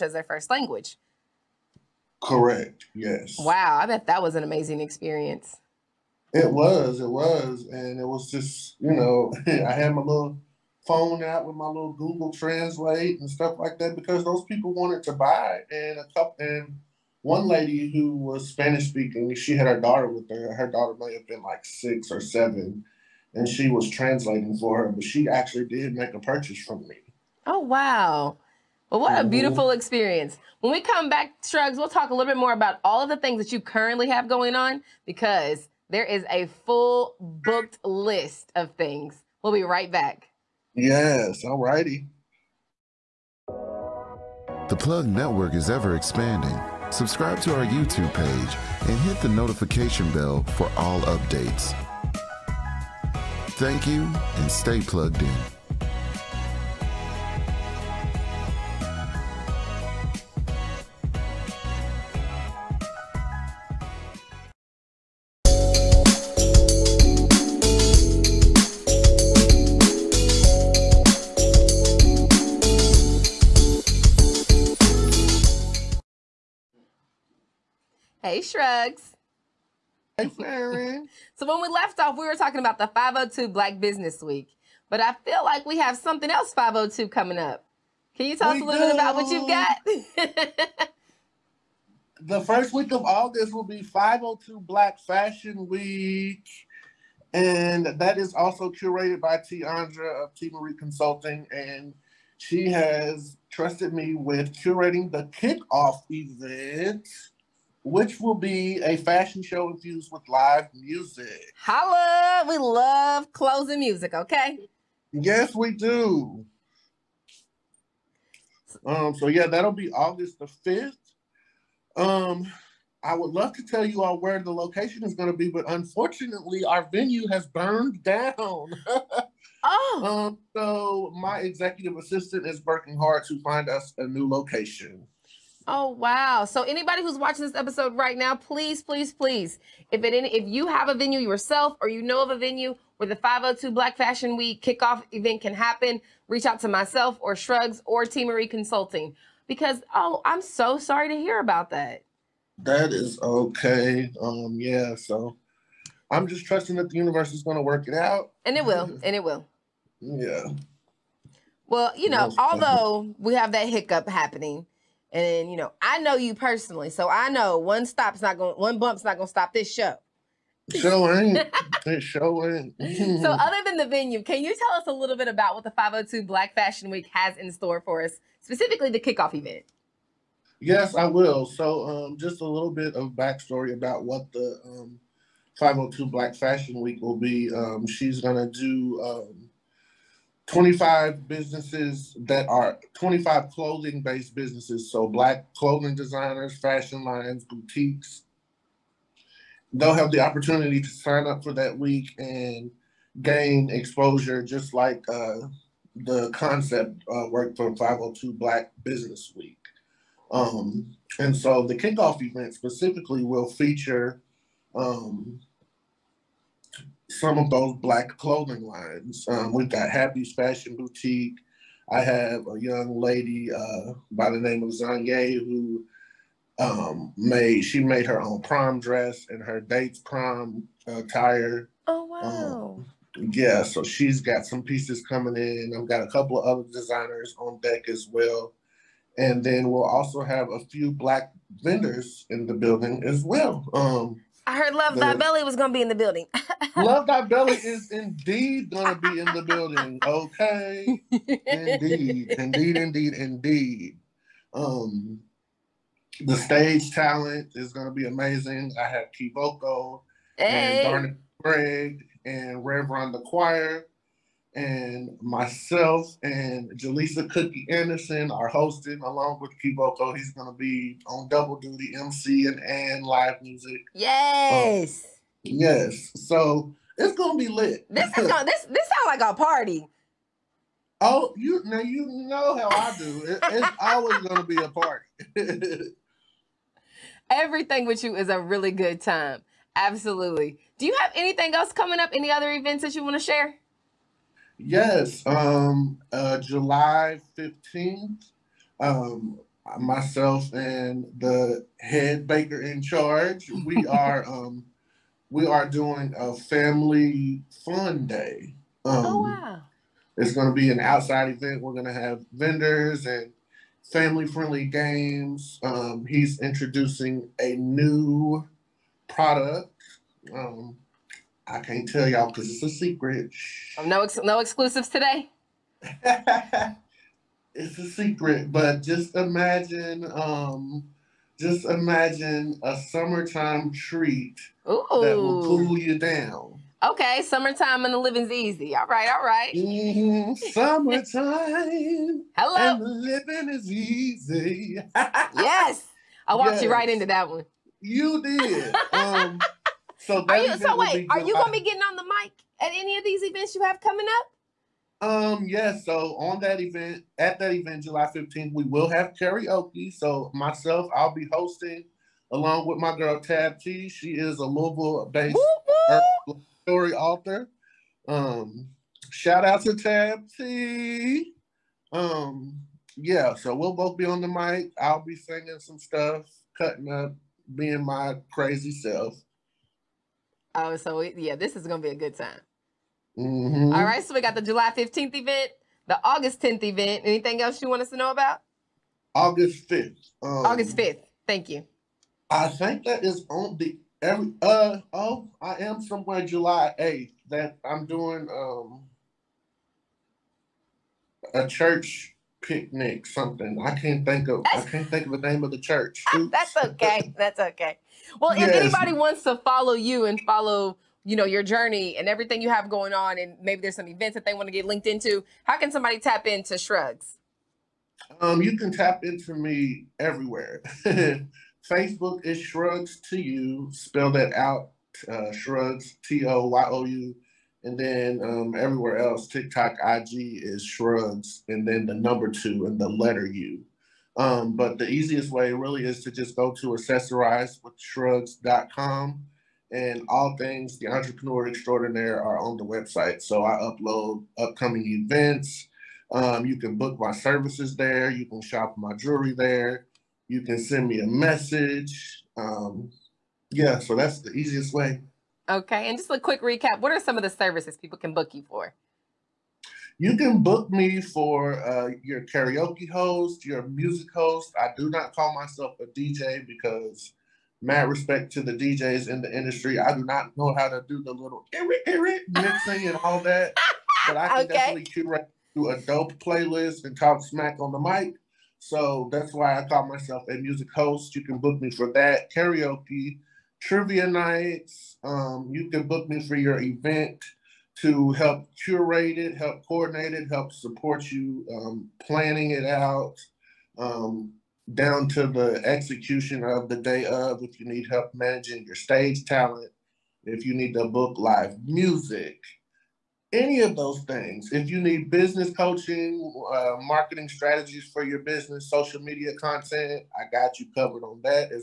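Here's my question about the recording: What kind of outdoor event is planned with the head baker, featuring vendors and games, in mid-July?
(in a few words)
Family fun day.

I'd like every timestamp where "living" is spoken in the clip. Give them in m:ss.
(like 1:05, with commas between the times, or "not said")
5:37, 5:42.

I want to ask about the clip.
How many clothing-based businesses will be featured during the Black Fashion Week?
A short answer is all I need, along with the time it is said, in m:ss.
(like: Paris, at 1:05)
25, at 3:12.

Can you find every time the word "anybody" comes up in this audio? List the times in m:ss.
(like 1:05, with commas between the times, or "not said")
2:16, 6:48.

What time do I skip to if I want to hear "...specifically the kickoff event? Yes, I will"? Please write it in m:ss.
2:58.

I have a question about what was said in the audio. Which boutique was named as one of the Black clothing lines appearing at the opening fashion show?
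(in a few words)
Happy's Fashion Boutique.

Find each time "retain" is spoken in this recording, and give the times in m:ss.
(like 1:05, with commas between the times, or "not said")
not said.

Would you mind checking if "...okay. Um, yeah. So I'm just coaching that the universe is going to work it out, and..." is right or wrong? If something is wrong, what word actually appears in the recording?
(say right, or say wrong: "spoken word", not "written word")
wrong: "trusting", not "coaching".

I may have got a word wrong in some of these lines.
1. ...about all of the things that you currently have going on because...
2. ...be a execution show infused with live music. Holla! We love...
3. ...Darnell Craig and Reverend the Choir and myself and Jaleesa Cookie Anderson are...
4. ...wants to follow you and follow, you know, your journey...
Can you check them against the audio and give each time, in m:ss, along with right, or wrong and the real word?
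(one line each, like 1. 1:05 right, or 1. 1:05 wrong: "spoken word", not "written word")
1. 0:32 right
2. 1:48 wrong: "fashion", not "execution"
3. 4:20 right
4. 6:48 right.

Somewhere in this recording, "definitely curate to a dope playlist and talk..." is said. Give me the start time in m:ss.
7:54.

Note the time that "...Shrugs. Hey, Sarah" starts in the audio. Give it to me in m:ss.
1:18.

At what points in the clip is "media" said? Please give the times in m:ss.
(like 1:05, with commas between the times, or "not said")
8:29.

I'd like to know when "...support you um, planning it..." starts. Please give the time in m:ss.
8:10.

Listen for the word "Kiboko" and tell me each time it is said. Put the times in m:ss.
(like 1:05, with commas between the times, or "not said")
4:19, 4:29.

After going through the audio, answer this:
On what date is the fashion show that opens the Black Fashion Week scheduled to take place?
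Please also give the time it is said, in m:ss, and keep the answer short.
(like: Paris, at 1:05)
August 5th, at 1:59.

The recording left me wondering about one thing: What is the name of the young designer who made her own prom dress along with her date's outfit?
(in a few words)
Zanye.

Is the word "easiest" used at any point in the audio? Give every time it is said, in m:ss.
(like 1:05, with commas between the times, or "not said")
7:14, 7:34.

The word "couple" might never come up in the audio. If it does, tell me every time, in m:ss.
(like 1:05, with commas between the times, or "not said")
0:16, 3:56.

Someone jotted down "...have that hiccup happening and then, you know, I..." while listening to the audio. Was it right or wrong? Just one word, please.
right.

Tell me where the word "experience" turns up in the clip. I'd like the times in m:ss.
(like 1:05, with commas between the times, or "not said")
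0:04, 0:29.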